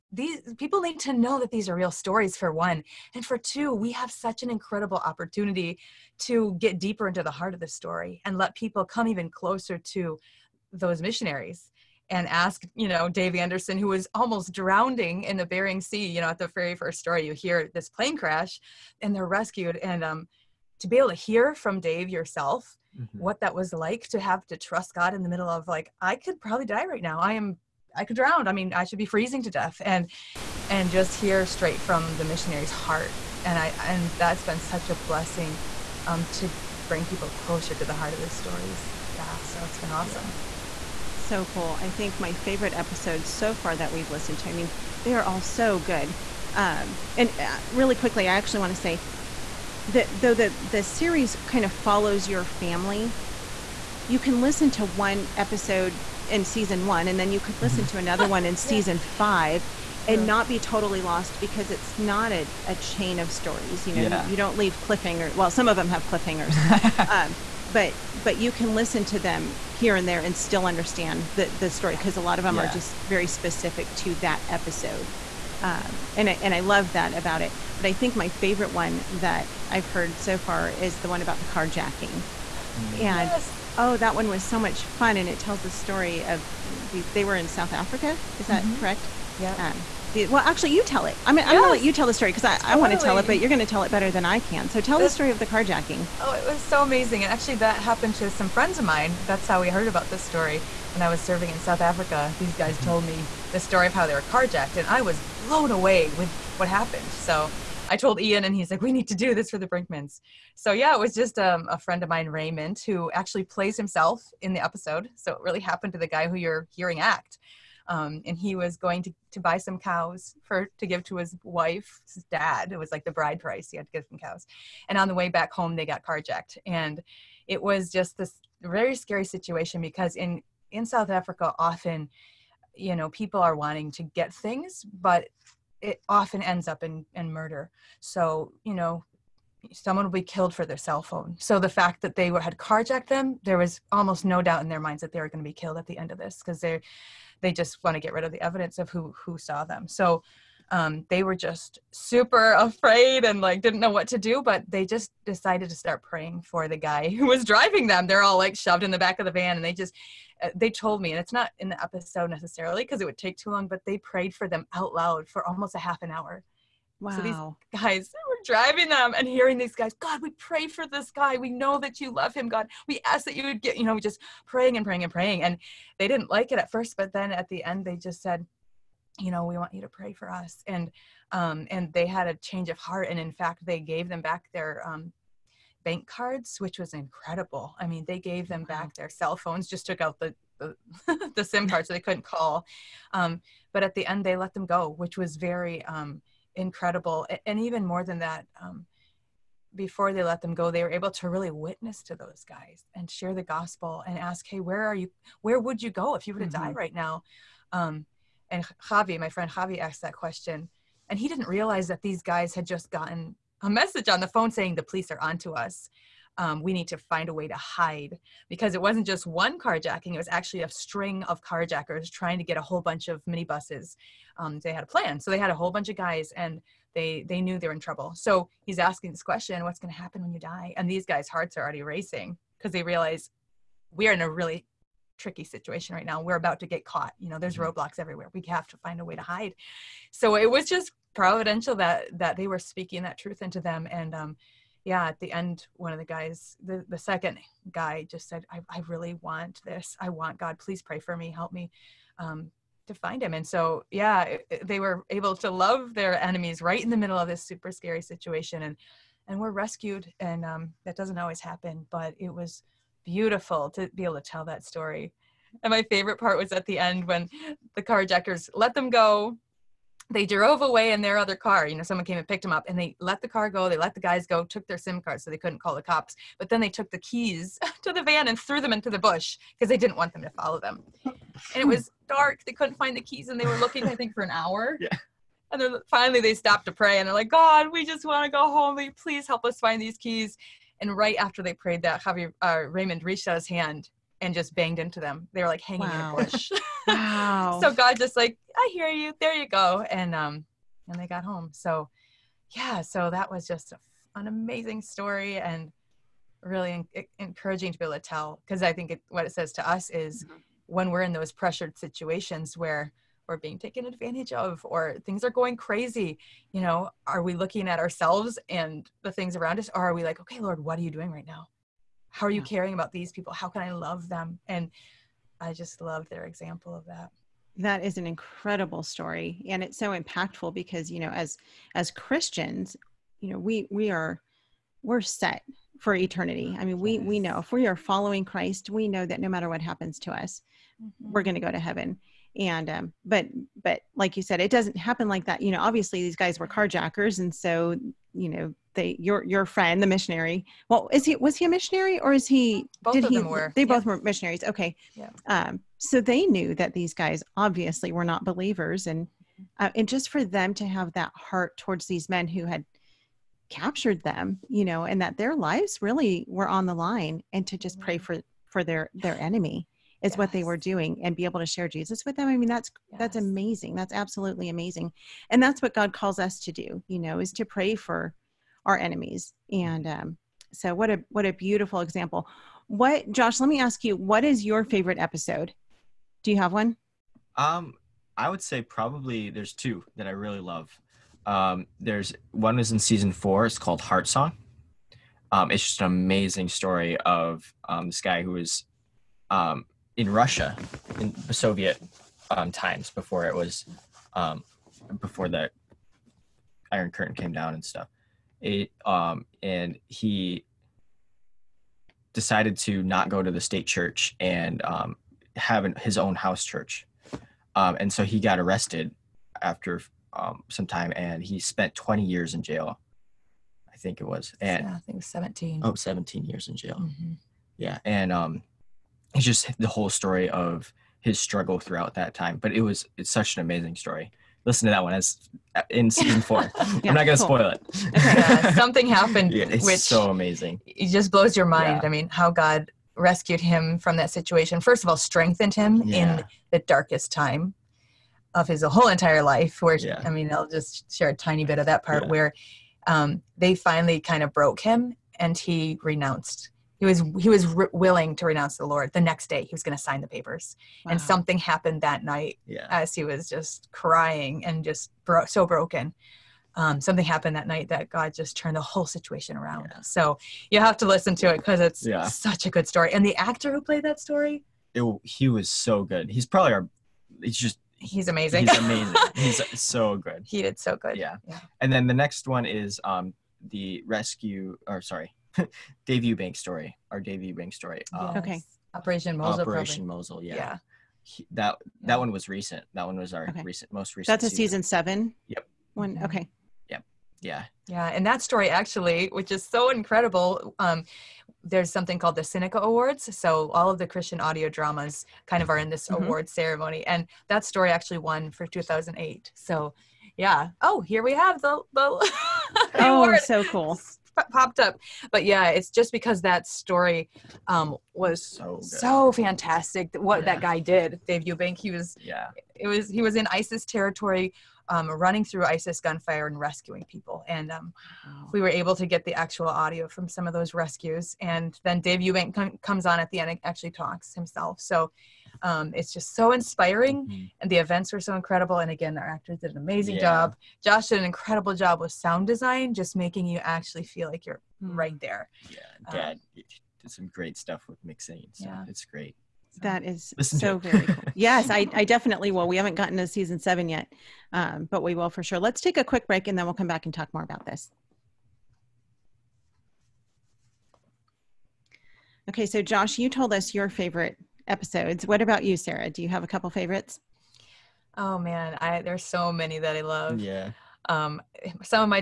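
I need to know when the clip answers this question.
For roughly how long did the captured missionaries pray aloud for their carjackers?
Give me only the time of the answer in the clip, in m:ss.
2:45.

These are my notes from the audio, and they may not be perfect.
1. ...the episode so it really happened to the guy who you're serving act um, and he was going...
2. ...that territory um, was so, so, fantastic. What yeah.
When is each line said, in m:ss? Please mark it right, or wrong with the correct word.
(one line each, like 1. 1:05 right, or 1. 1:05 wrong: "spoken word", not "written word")
1. 1:54 wrong: "hearing", not "serving"
2. 8:36 wrong: "story", not "territory".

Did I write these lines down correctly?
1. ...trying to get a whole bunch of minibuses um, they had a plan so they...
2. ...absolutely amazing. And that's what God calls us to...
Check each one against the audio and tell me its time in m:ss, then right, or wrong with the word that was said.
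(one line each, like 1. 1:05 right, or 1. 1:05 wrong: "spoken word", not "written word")
1. 3:42 right
2. 6:13 right.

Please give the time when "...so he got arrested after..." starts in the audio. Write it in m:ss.
6:57.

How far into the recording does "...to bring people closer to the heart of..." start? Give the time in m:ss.
0:36.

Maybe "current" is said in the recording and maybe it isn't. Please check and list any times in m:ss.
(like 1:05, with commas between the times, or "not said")
not said.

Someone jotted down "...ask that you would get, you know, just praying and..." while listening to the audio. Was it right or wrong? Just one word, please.
right.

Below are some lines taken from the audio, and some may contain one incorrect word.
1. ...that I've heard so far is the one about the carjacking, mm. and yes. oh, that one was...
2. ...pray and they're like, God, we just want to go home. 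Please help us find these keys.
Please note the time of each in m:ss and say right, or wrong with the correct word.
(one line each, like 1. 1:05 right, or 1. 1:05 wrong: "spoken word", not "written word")
1. 1:19 right
2. 4:46 right.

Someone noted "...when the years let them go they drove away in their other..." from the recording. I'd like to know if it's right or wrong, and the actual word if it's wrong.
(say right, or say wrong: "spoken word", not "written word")
wrong: "carjackers", not "years".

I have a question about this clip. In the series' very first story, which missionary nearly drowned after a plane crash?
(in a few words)
Dave Anderson.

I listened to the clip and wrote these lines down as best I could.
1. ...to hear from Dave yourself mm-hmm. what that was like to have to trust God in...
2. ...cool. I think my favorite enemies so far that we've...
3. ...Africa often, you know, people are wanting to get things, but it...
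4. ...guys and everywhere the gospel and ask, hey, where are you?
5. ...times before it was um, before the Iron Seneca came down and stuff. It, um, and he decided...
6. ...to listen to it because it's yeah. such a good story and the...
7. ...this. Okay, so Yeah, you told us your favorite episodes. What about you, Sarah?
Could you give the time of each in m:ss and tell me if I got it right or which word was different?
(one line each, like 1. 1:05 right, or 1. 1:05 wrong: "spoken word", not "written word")
1. 0:21 right
2. 0:41 wrong: "episodes", not "enemies"
3. 2:11 right
4. 3:22 wrong: "share", not "everywhere"
5. 6:42 wrong: "Curtain", not "Seneca"
6. 7:50 right
7. 9:17 wrong: "Josh", not "Yeah".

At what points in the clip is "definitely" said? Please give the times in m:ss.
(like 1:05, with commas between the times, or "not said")
9:11.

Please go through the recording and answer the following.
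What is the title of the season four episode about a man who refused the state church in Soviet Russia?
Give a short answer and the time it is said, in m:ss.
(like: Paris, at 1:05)
Heart Song, at 6:33.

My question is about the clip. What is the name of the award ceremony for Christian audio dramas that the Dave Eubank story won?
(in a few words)
Seneca Awards.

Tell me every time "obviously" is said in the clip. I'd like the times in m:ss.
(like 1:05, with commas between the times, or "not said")
5:45, 5:57.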